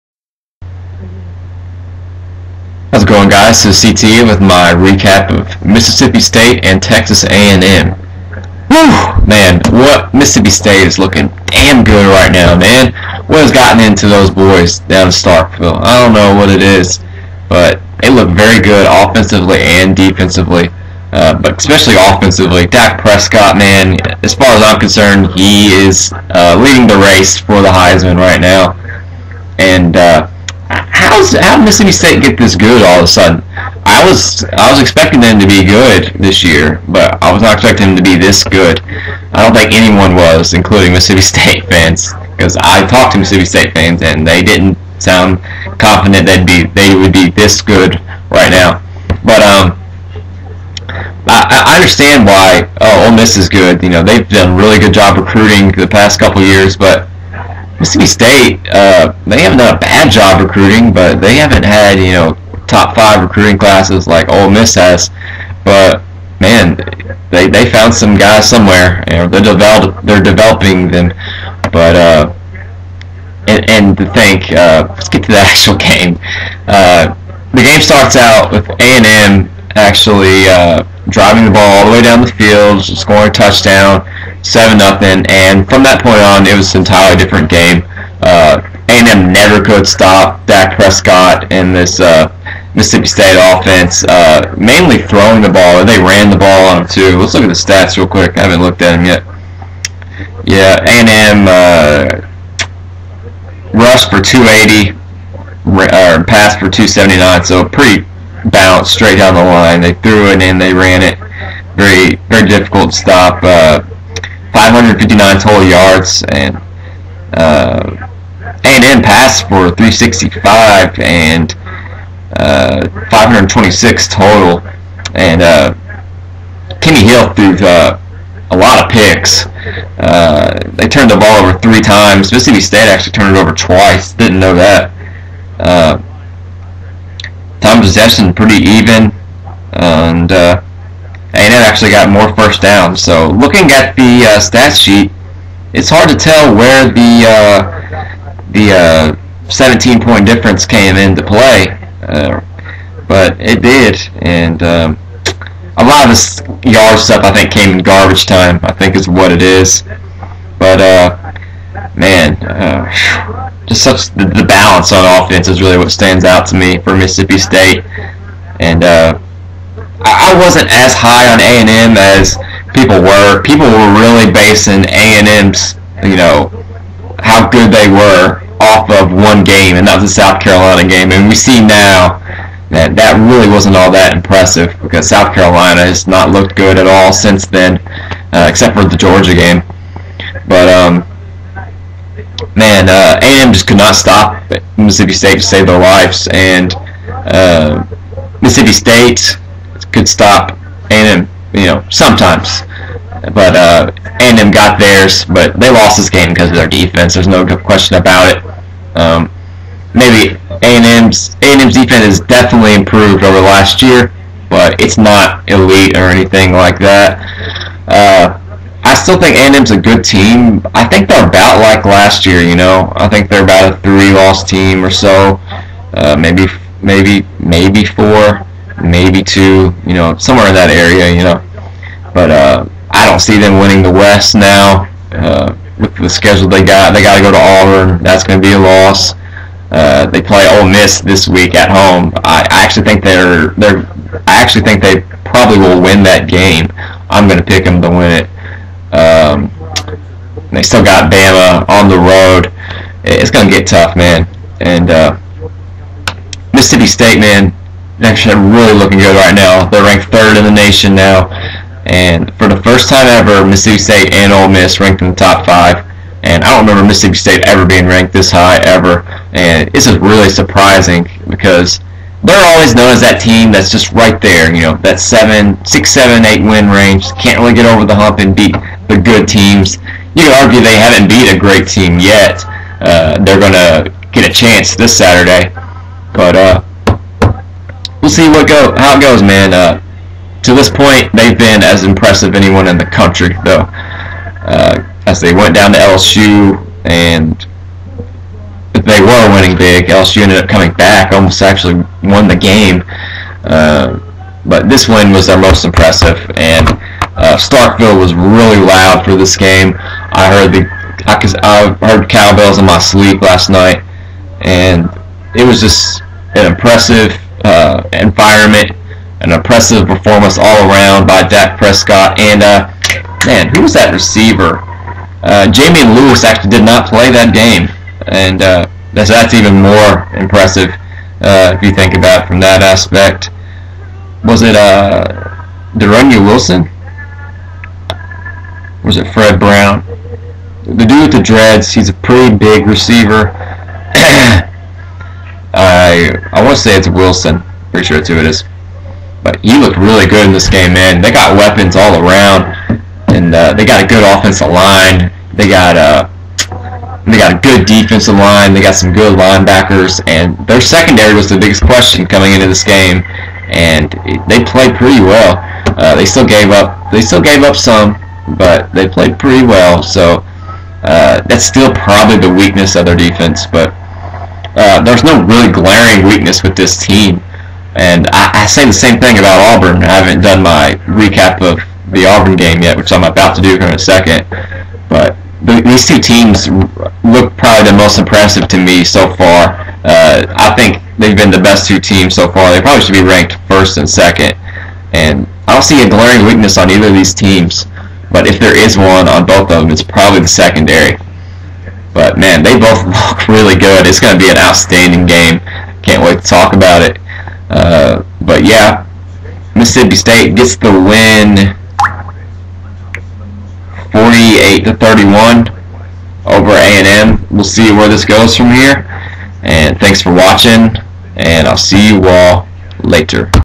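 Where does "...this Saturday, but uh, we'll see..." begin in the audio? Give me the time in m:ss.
4:44.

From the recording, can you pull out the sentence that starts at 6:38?
But if there is one on both of them, it's probably the secondary.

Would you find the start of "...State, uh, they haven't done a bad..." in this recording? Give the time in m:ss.
0:58.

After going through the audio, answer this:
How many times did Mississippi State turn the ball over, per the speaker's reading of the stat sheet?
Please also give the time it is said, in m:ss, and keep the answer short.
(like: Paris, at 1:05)
2, at 2:12.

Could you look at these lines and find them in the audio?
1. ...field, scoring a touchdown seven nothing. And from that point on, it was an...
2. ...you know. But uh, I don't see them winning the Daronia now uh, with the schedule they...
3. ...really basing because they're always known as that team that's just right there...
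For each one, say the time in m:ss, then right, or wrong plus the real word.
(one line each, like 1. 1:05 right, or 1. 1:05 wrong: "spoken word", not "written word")
1. 1:22 right
2. 3:51 wrong: "West", not "Daronia"
3. 4:29 wrong: "surprising", not "basing".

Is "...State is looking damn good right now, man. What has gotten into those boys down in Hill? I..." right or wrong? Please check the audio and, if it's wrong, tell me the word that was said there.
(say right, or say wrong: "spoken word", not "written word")
wrong: "Starkville", not "Hill".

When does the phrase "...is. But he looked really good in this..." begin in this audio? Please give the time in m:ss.
5:48.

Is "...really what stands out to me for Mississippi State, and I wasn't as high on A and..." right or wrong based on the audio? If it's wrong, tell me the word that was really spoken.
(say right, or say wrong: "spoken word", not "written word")
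right.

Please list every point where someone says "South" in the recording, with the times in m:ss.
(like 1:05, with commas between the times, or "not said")
3:00, 3:05.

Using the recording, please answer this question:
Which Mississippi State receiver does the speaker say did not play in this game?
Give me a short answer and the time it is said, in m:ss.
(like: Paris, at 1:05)
Jamie Lewis, at 5:25.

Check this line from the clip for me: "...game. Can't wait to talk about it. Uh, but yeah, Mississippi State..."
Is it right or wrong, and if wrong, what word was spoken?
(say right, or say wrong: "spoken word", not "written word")
right.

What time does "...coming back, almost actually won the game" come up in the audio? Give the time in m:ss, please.
5:00.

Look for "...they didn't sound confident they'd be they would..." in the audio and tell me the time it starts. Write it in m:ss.
0:44.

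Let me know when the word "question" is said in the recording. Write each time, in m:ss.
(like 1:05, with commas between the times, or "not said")
3:27, 6:01.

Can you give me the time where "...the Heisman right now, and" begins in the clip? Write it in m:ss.
0:27.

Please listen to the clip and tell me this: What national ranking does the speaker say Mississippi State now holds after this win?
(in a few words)
3rd.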